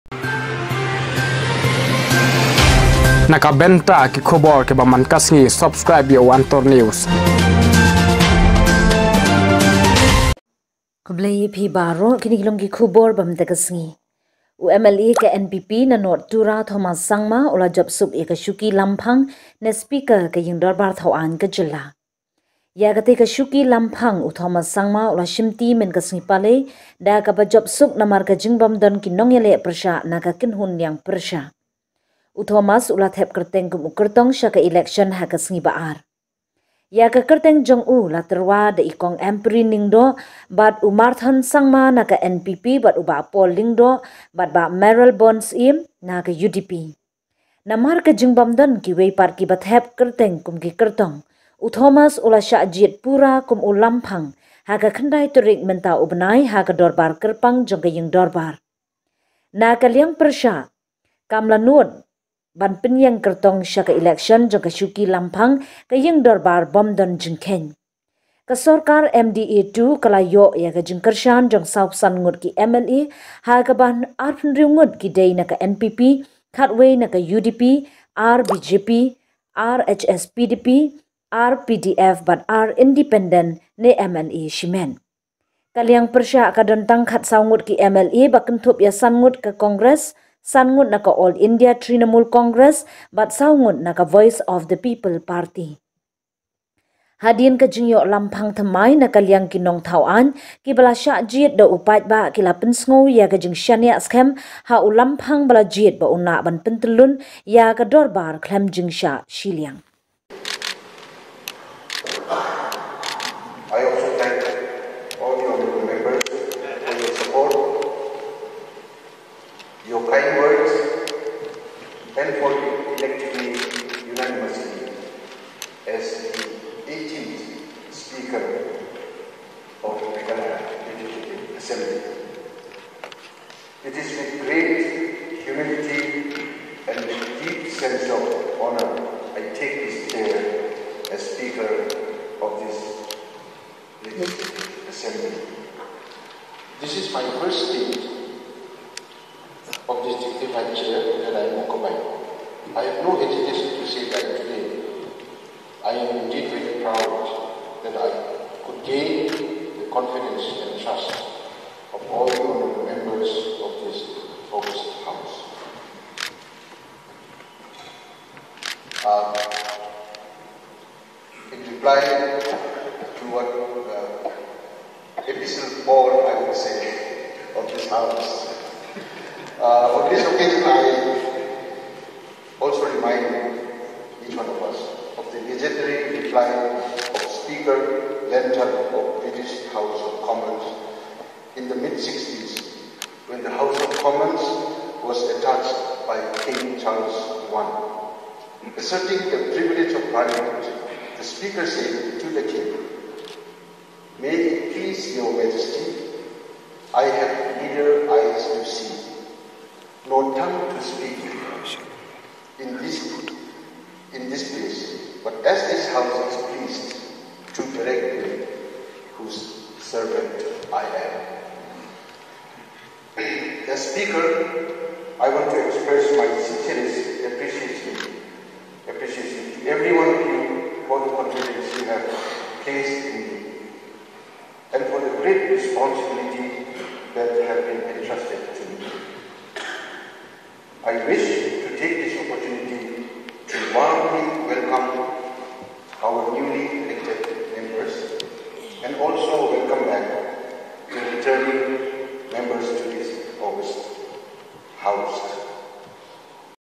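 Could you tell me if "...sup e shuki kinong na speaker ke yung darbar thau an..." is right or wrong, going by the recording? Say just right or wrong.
wrong.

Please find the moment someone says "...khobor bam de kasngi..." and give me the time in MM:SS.
00:12.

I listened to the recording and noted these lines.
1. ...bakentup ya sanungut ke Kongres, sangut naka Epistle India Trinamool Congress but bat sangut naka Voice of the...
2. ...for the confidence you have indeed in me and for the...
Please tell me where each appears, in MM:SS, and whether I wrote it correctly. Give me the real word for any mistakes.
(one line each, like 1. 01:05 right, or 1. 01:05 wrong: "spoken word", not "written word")
1. 01:28 wrong: "All", not "Epistle"
2. 03:50 wrong: "placed", not "indeed".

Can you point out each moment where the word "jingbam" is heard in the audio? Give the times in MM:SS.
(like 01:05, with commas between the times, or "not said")
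00:28, 00:48.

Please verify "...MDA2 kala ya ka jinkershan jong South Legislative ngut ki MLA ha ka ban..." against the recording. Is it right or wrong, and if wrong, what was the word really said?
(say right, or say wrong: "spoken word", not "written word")
wrong: "Sun", not "Legislative".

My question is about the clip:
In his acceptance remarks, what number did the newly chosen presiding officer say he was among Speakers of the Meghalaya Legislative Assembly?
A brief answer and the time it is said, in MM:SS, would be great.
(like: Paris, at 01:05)
18th, at 02:06.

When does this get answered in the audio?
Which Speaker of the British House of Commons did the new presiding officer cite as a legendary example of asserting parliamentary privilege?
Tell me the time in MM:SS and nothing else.
03:07.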